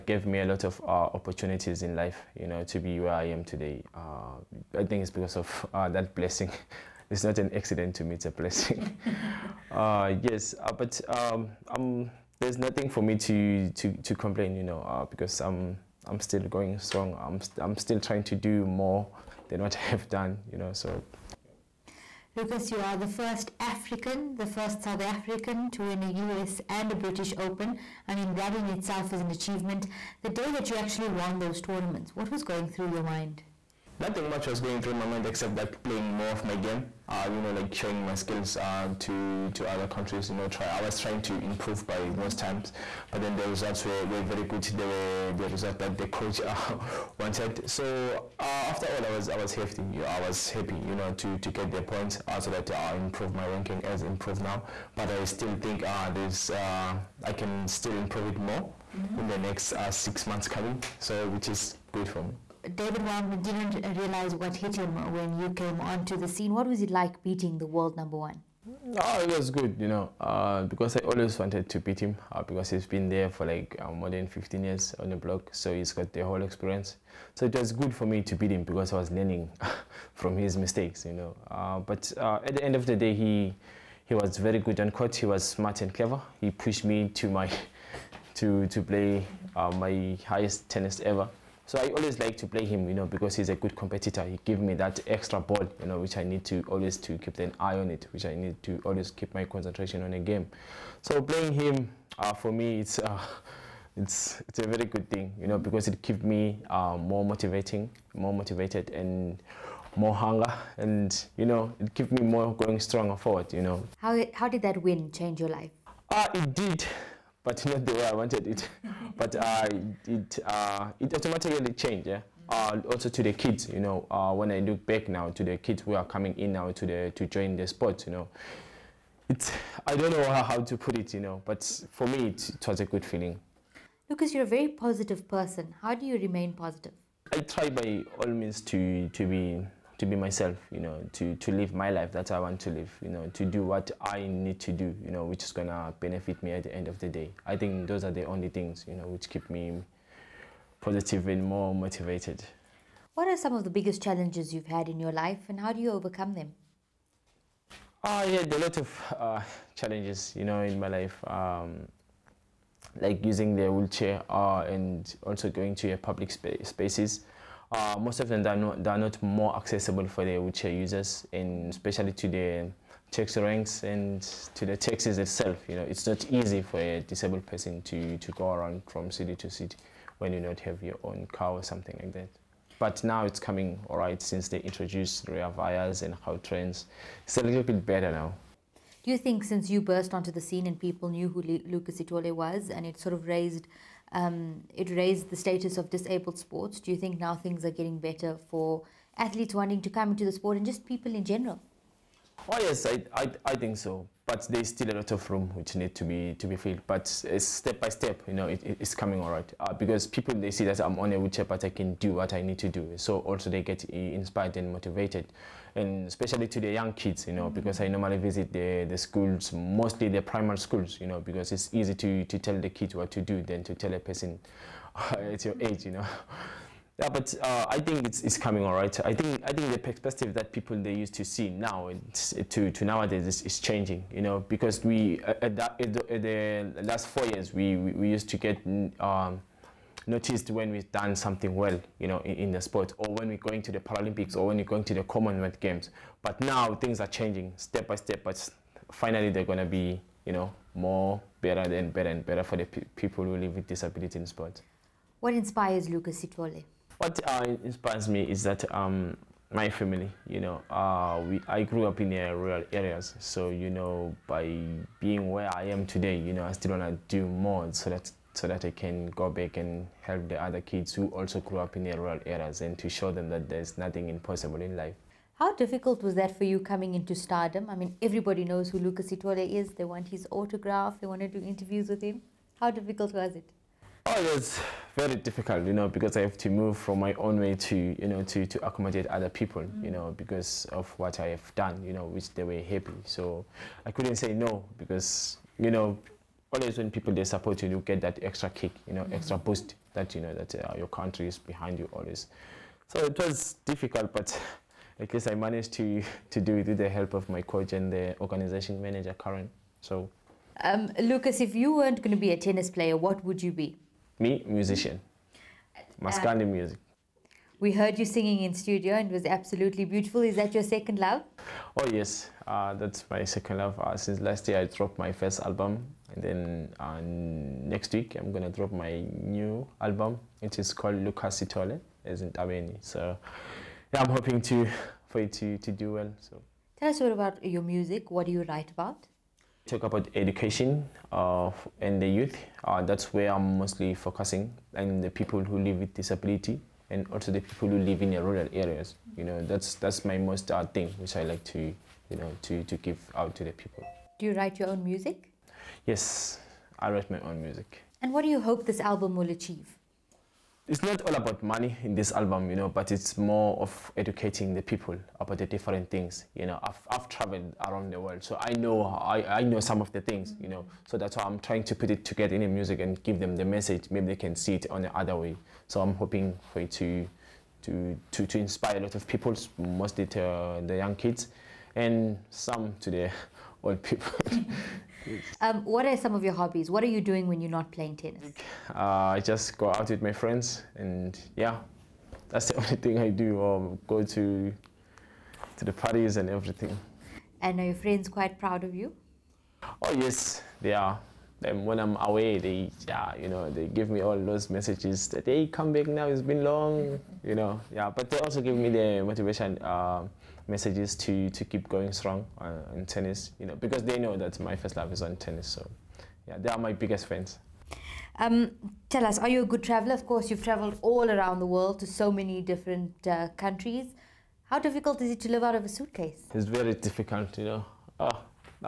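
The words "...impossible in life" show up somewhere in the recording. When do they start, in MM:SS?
04:34.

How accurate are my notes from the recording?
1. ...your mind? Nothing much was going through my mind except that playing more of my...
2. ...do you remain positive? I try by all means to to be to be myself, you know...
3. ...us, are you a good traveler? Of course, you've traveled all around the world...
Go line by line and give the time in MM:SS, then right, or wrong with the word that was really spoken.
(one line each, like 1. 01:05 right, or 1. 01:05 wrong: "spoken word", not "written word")
1. 00:32 right
2. 02:15 right
3. 06:59 right.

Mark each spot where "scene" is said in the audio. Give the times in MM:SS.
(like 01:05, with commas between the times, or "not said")
01:06, 03:10.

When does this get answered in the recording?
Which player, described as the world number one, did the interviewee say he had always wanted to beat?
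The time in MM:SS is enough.
01:02.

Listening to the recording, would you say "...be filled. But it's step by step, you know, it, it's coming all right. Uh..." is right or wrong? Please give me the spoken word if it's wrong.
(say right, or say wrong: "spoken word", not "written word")
right.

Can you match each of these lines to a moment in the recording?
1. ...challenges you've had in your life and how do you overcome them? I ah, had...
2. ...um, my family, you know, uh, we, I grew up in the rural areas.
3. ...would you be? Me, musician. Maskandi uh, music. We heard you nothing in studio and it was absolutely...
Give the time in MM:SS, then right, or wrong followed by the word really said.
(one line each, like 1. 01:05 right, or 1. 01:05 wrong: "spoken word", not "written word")
1. 02:34 right
2. 04:18 right
3. 05:13 wrong: "singing", not "nothing".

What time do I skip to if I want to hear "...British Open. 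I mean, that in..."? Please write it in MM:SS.
00:26.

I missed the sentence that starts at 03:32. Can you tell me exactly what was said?
So also they get inspired and motivated, and especially to the young kids, you know, because I mm-hmm.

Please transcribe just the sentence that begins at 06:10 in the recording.
So that's why I'm trying to put it together in the music and give them the message.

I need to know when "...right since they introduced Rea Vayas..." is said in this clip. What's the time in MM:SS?
03:03.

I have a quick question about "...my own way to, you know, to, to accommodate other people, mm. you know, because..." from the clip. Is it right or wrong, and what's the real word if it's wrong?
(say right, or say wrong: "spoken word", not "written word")
right.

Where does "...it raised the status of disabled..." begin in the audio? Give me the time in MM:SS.
03:14.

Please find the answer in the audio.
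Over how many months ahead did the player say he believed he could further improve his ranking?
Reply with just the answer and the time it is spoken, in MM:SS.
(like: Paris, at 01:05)
6, at 00:59.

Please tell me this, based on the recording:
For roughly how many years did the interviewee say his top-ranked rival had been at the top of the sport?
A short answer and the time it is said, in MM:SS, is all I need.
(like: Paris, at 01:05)
15, at 01:14.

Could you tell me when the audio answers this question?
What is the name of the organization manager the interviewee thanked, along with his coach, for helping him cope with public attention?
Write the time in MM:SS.
05:09.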